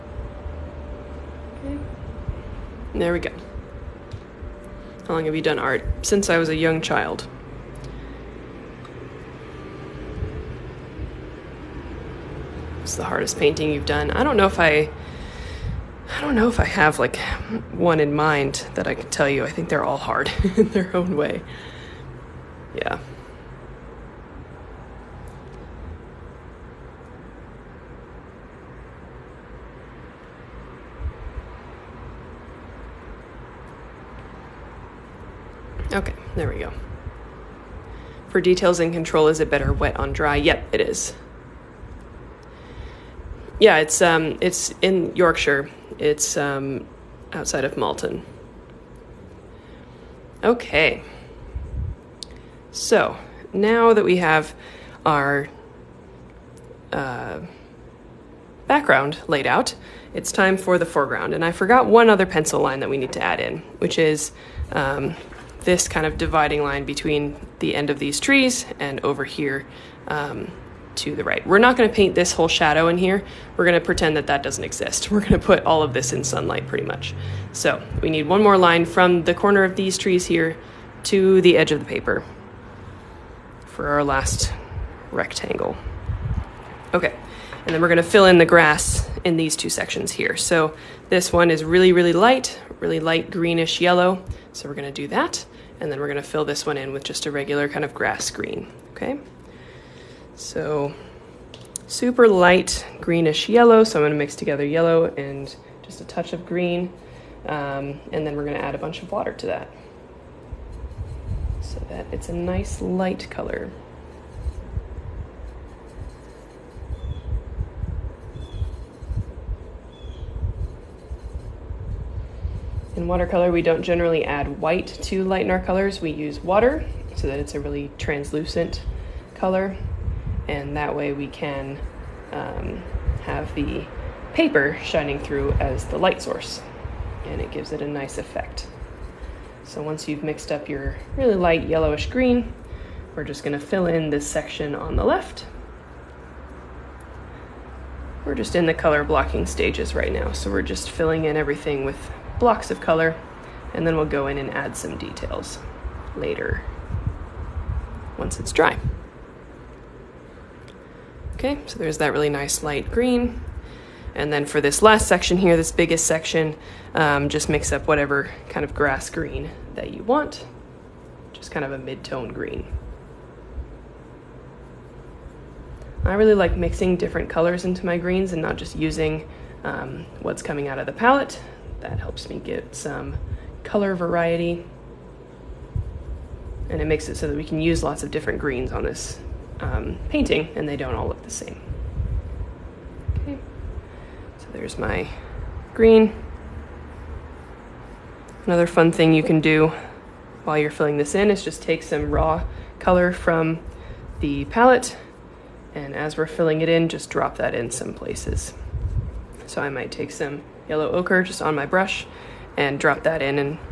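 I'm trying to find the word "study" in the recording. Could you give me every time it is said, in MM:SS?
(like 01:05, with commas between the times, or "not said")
not said.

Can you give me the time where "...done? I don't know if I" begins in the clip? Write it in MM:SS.
00:13.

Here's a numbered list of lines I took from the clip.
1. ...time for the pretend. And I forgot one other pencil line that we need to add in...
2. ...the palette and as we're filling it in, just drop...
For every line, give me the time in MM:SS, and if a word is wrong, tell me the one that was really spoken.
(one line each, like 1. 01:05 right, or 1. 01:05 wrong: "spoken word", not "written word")
1. 01:00 wrong: "foreground", not "pretend"
2. 03:24 right.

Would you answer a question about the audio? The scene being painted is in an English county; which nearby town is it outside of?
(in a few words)
Malton.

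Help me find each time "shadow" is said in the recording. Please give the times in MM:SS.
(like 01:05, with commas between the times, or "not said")
01:12.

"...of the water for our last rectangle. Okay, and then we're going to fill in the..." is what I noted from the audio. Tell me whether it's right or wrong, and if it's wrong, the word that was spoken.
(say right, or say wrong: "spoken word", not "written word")
wrong: "paper", not "water".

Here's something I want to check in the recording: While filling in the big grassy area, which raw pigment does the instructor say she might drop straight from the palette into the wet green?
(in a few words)
Yellow ochre.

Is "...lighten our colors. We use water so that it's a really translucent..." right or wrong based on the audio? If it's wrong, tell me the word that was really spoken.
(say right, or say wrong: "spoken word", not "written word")
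right.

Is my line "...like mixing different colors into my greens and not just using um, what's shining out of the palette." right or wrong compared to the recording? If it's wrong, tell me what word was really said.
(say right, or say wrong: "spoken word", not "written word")
wrong: "coming", not "shining".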